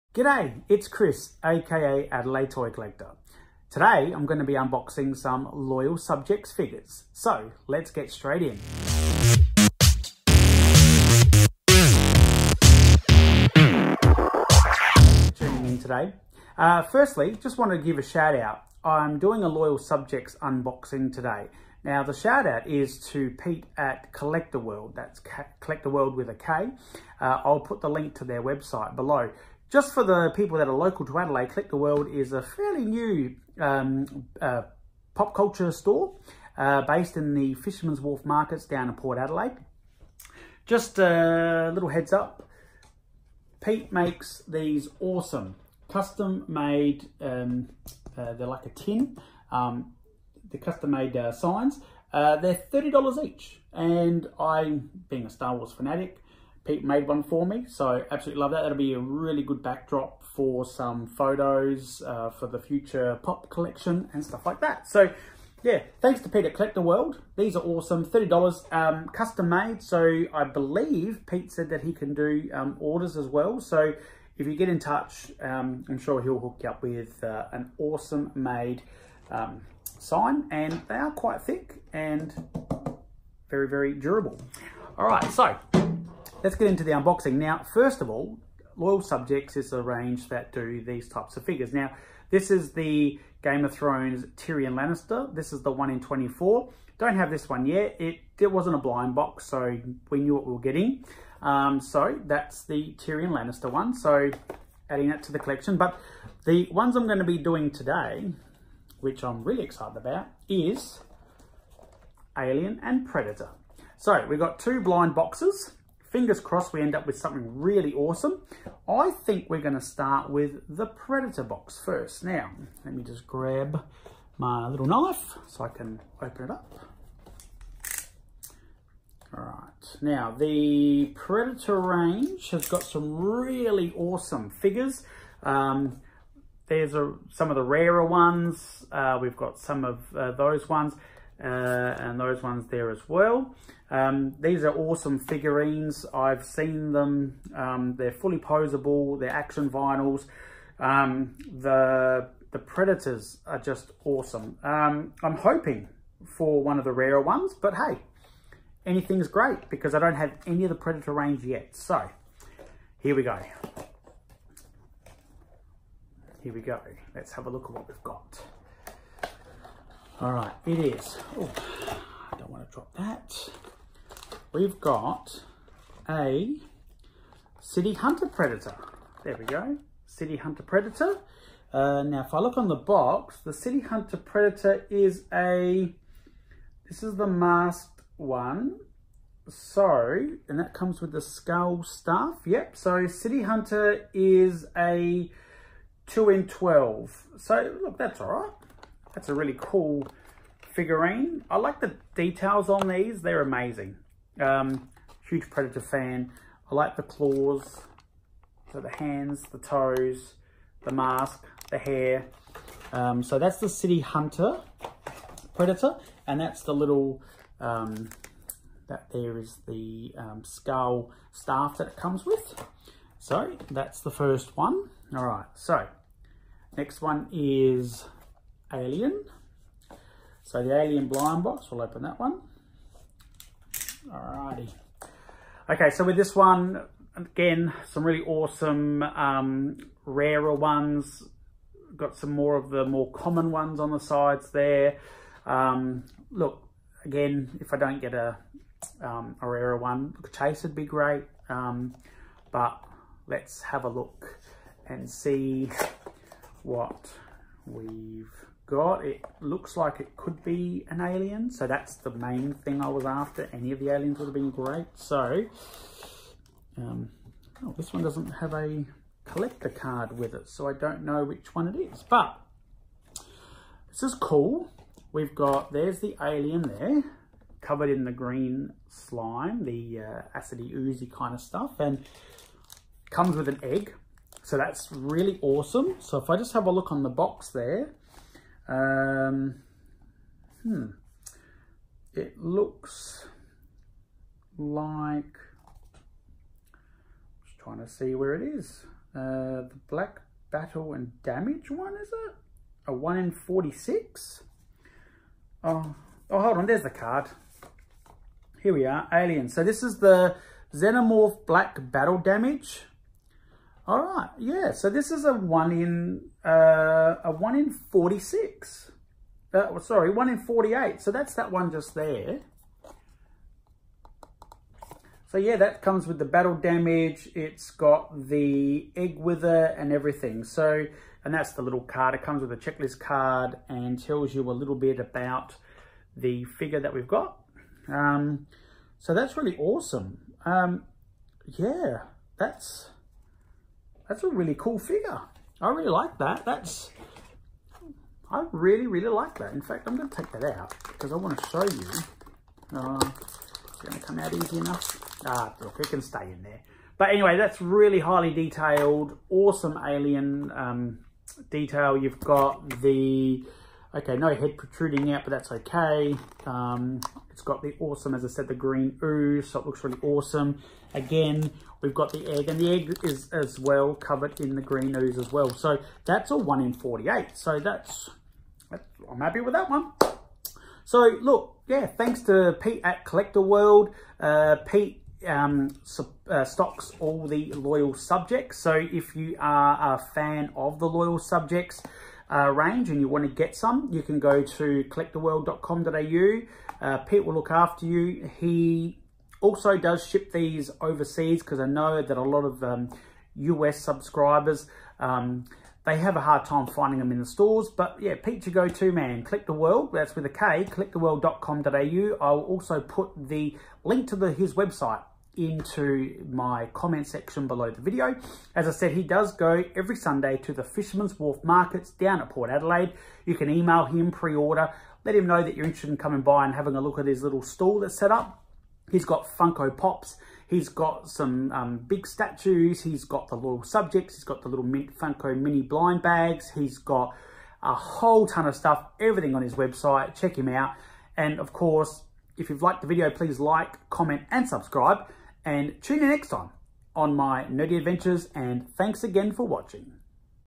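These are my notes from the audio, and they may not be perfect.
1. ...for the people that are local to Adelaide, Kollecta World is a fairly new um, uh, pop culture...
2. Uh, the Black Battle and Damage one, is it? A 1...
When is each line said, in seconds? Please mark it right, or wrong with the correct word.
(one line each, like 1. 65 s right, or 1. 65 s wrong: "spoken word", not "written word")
1. 29 s right
2. 299 s right.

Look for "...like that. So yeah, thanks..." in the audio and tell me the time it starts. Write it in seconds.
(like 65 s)
64 s.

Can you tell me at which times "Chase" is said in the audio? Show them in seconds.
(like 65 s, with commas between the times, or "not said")
250 s.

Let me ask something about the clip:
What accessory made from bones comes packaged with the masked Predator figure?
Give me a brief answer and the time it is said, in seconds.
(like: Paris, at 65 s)
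skull staff, at 220 s.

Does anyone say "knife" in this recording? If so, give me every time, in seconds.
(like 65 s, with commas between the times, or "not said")
124 s.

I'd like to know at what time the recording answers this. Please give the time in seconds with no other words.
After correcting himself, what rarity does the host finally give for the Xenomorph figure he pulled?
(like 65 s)
320 s.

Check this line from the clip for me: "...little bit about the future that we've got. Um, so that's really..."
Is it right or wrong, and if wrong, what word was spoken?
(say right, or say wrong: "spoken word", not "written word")
wrong: "figure", not "future".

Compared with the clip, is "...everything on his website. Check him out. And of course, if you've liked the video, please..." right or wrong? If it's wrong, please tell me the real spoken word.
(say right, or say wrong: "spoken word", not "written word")
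right.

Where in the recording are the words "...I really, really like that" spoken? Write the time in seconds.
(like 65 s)
348 s.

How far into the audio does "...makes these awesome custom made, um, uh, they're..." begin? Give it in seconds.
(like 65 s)
43 s.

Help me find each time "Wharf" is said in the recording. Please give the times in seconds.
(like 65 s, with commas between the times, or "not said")
38 s, 421 s.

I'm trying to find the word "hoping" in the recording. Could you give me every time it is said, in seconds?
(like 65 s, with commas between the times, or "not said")
155 s.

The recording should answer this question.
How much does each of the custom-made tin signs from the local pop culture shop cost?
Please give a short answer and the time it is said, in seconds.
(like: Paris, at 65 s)
$30, at 52 s.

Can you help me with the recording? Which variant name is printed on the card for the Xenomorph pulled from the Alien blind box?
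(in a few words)
Black Battle Damage.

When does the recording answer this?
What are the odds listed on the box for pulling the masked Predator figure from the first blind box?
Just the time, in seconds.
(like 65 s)
193 s.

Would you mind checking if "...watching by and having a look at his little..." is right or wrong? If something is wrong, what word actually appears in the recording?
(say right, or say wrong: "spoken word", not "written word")
wrong: "coming", not "watching".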